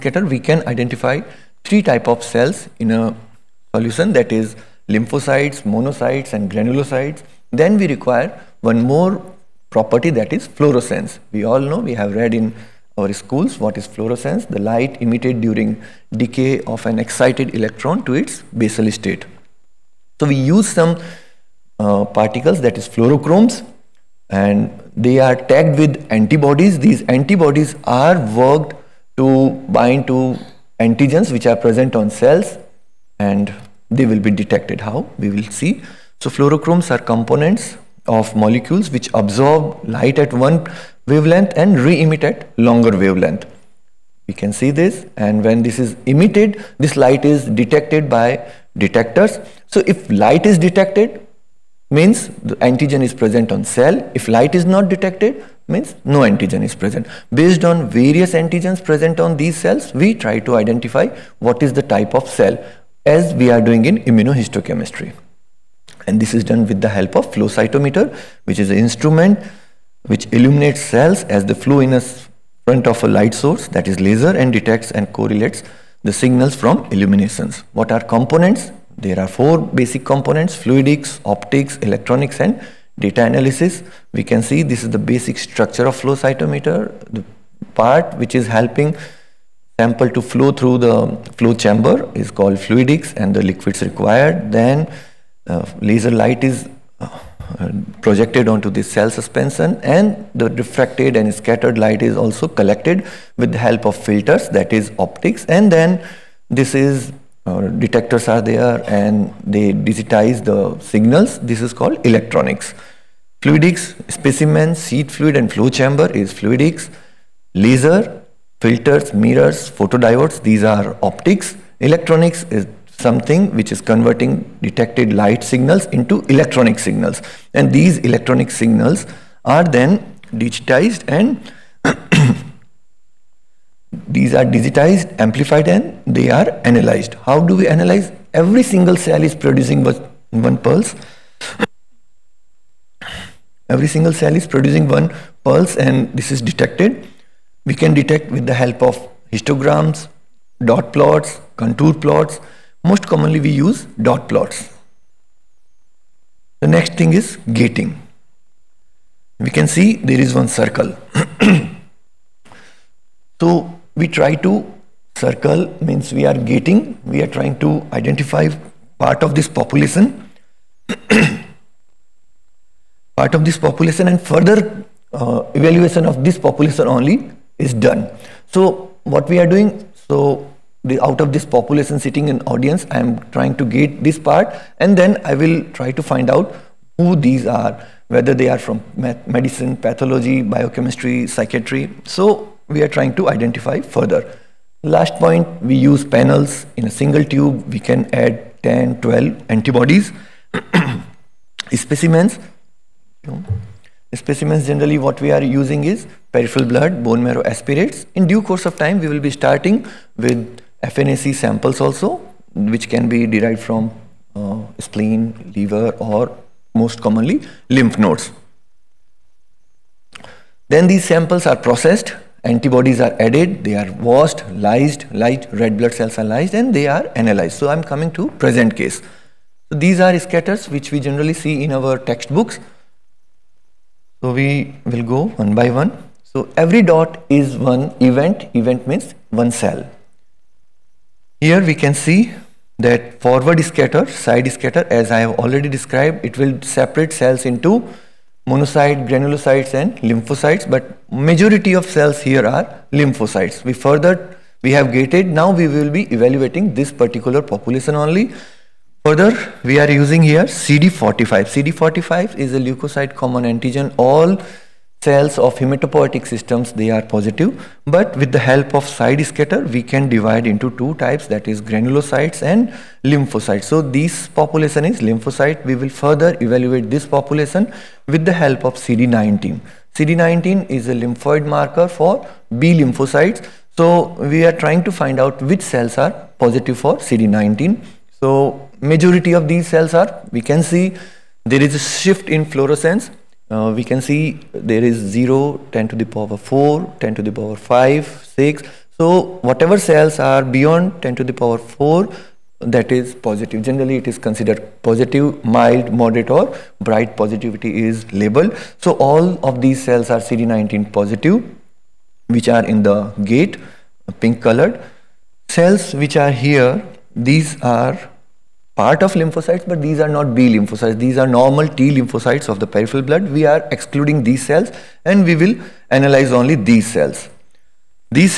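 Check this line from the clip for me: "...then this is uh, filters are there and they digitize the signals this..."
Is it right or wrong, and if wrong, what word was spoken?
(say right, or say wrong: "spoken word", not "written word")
wrong: "detectors", not "filters".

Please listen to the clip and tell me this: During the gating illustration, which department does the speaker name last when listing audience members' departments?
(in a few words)
psychiatry.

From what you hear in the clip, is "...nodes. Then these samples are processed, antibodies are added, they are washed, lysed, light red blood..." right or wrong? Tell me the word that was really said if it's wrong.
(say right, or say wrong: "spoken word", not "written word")
right.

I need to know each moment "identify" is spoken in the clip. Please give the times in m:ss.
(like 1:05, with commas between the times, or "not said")
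0:00, 1:00, 2:47, 3:13.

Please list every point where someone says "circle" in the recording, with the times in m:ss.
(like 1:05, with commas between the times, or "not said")
2:40, 2:45.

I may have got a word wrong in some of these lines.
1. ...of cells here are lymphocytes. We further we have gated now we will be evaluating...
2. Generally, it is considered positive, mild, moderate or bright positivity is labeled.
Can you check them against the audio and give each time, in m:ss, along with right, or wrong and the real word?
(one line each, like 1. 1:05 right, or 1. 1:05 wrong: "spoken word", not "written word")
1. 4:11 right
2. 5:03 right.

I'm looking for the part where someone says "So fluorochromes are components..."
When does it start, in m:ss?
0:36.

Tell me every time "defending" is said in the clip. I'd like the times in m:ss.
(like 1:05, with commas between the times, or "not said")
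not said.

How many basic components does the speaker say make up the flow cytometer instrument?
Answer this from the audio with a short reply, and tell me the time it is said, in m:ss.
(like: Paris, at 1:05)
4, at 1:19.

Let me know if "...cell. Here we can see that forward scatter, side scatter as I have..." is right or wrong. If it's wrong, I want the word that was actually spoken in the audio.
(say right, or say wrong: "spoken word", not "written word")
right.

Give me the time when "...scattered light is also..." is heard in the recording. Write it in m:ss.
1:41.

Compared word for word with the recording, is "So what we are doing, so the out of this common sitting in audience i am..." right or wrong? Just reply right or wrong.
wrong.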